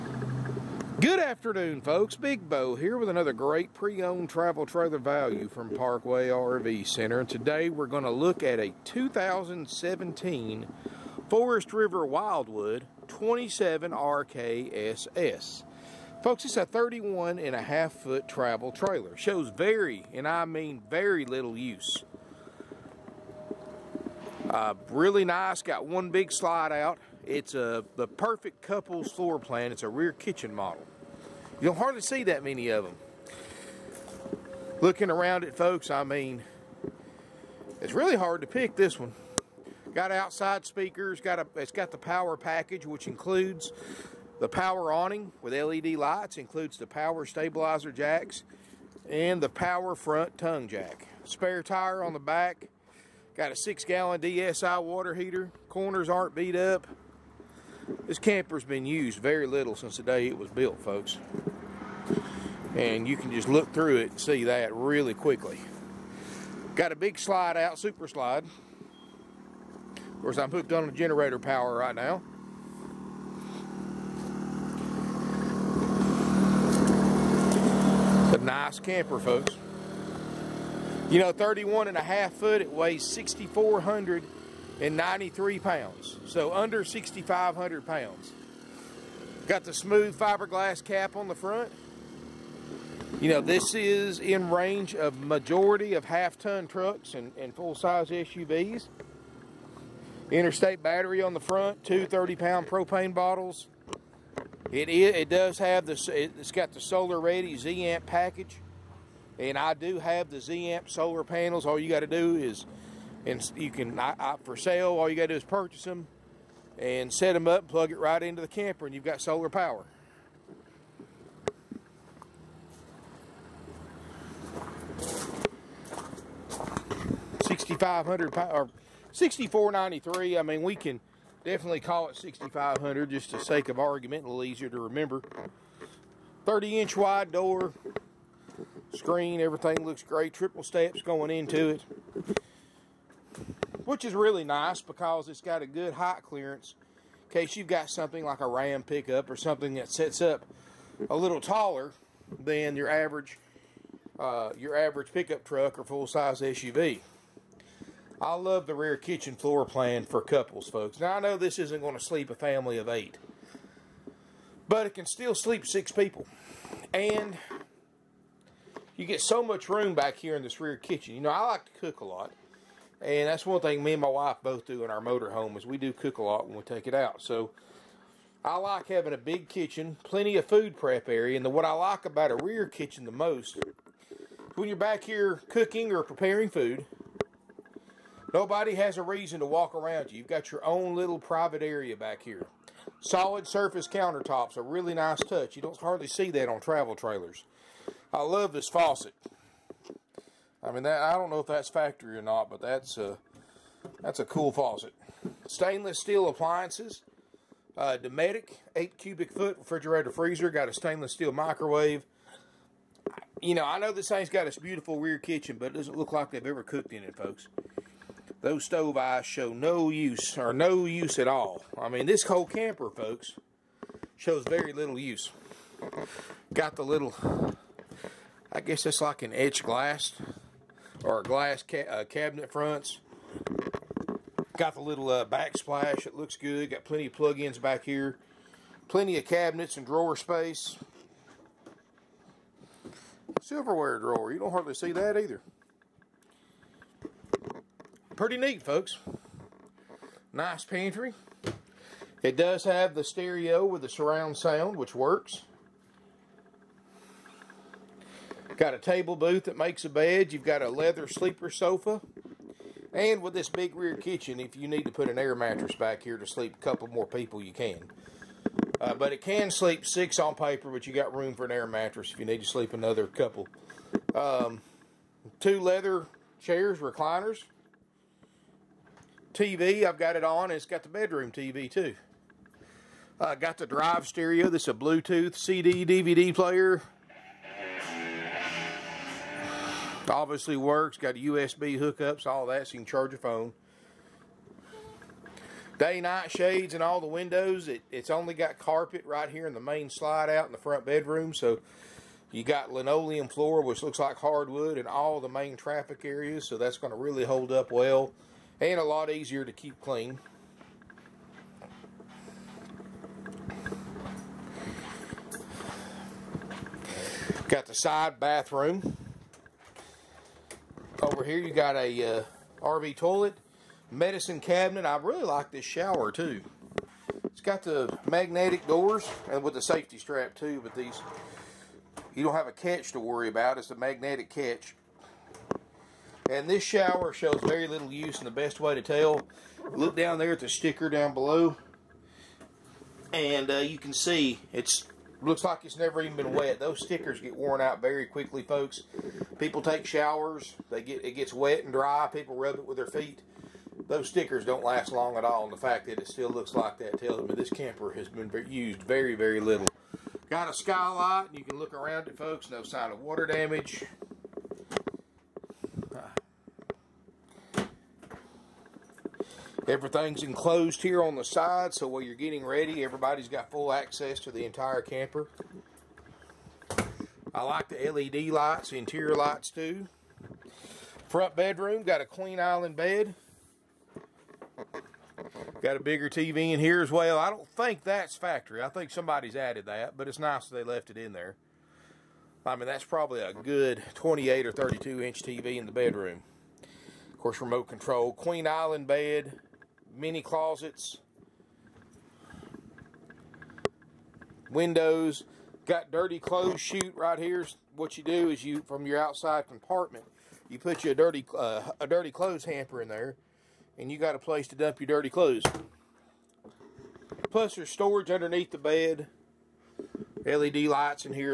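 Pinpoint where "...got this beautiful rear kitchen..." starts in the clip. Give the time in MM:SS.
03:34.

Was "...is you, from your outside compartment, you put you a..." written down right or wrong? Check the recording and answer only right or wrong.
right.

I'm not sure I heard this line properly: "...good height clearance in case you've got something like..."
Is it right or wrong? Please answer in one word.
right.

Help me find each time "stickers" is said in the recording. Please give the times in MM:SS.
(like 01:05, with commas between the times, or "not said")
05:40, 05:46, 05:54.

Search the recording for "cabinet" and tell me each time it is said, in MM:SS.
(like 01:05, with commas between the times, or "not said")
03:52, 03:59, 05:24.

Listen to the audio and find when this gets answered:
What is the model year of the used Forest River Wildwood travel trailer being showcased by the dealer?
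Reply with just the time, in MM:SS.
00:08.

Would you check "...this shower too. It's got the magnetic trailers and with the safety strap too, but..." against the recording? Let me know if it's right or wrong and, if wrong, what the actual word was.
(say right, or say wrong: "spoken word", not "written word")
wrong: "doors", not "trailers".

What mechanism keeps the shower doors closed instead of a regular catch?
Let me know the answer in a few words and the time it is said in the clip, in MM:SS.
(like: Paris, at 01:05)
magnetic catch, at 05:33.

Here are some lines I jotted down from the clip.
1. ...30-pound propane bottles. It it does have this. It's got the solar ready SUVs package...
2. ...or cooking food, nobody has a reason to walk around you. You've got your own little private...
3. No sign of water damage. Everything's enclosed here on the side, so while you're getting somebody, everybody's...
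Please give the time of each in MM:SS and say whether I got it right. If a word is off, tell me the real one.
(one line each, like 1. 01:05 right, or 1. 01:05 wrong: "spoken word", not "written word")
1. 01:42 wrong: "Zamp", not "SUVs"
2. 03:05 wrong: "preparing", not "cooking"
3. 06:02 wrong: "ready", not "somebody".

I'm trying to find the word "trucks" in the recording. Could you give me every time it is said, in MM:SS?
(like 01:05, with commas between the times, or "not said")
01:36, 02:35.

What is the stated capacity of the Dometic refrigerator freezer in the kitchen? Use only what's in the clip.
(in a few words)
8 cubic feet.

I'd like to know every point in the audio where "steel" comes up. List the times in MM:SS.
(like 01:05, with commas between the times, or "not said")
03:25, 03:31.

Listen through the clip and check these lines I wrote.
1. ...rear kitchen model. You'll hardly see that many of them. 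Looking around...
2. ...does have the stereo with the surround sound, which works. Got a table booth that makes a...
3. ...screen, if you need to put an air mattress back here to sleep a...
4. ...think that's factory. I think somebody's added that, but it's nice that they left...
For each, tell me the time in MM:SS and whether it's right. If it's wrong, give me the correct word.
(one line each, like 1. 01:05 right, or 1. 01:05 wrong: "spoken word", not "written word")
1. 00:29 right
2. 04:12 right
3. 04:23 wrong: "kitchen", not "screen"
4. 06:27 right.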